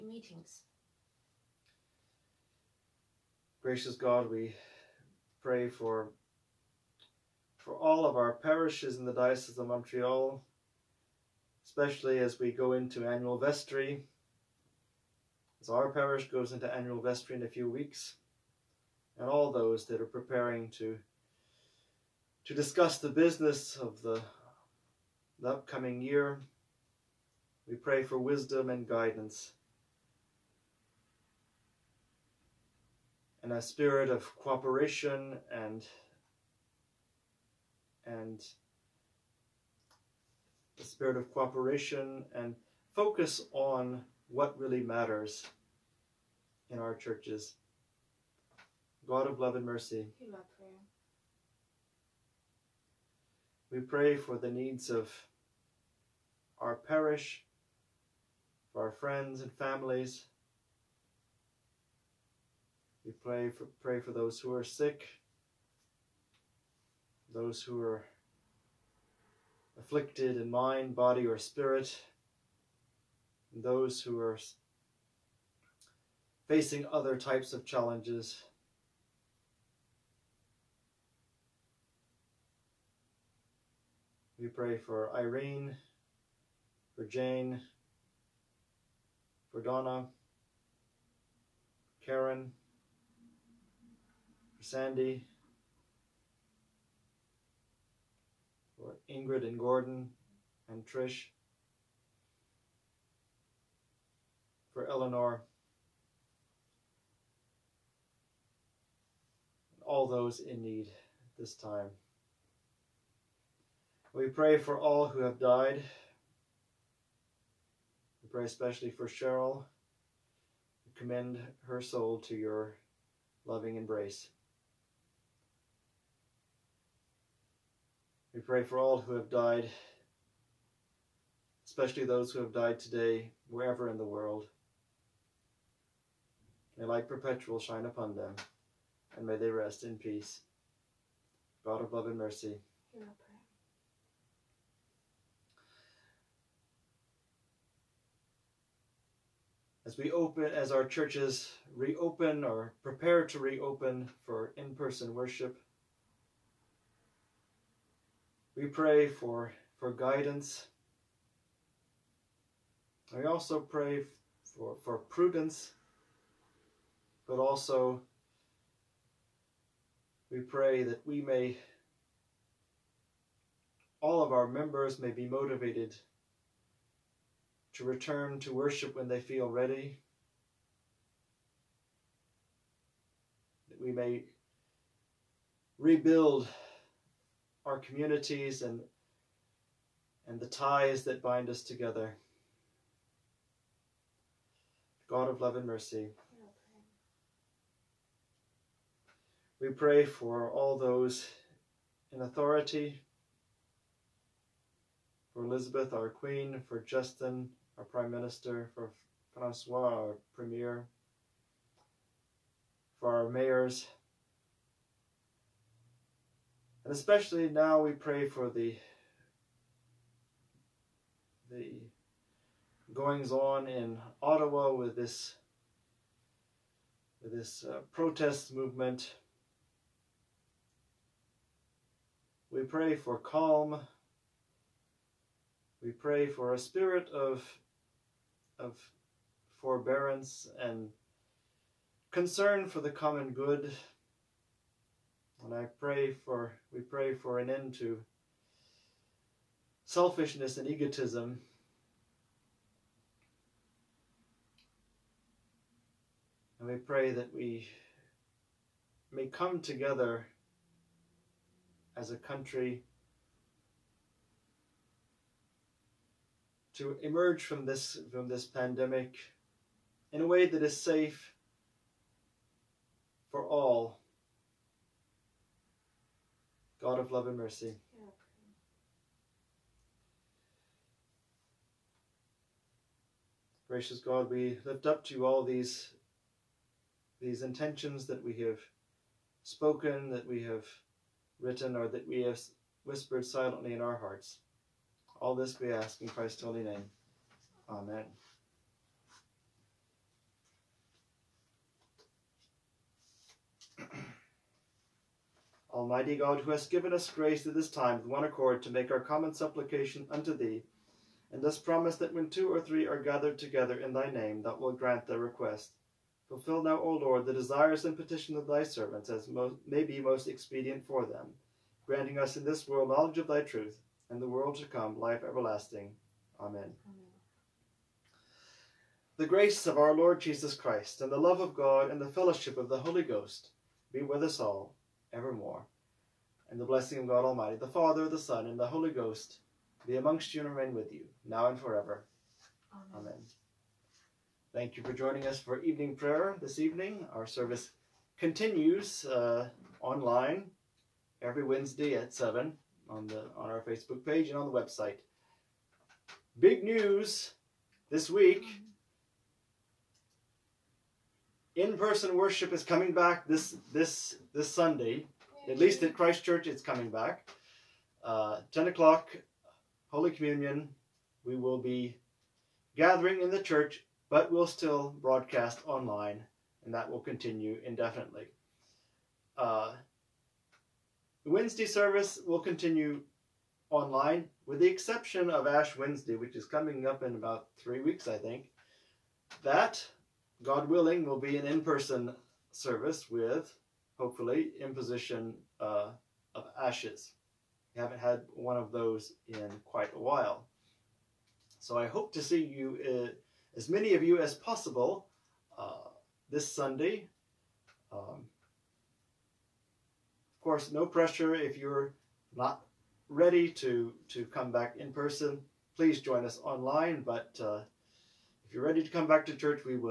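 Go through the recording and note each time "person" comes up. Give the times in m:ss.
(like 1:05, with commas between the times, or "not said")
2:34, 6:01, 6:31, 6:54.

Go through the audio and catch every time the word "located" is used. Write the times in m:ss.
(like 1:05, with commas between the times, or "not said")
not said.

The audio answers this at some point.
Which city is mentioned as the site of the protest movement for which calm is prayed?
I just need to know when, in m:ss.
3:44.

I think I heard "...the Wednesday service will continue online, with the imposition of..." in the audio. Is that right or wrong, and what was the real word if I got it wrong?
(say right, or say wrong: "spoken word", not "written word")
wrong: "exception", not "imposition".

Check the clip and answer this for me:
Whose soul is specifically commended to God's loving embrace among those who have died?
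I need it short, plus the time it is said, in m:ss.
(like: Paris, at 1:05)
Cheryl, at 1:59.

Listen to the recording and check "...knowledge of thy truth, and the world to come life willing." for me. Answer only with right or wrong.
wrong.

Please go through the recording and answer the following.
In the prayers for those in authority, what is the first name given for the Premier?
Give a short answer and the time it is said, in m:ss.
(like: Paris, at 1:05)
Francois, at 3:29.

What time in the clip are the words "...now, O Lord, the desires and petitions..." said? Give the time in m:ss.
5:16.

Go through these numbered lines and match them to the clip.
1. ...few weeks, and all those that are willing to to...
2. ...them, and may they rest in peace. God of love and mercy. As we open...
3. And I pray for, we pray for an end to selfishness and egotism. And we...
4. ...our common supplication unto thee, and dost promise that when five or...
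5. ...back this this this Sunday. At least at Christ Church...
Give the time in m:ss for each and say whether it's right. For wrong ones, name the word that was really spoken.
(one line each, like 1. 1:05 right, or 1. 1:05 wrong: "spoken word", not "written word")
1. 0:17 wrong: "preparing", not "willing"
2. 2:18 right
3. 4:05 right
4. 5:08 wrong: "two", not "five"
5. 6:02 right.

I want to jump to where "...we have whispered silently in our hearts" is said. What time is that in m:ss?
4:52.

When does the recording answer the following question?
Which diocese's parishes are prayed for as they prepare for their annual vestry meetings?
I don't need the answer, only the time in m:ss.
0:09.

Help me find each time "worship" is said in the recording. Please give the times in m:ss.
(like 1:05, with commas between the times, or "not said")
2:35, 2:58, 6:02.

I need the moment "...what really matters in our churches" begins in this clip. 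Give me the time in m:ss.
0:44.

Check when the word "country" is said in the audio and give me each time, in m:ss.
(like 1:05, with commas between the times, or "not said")
4:22.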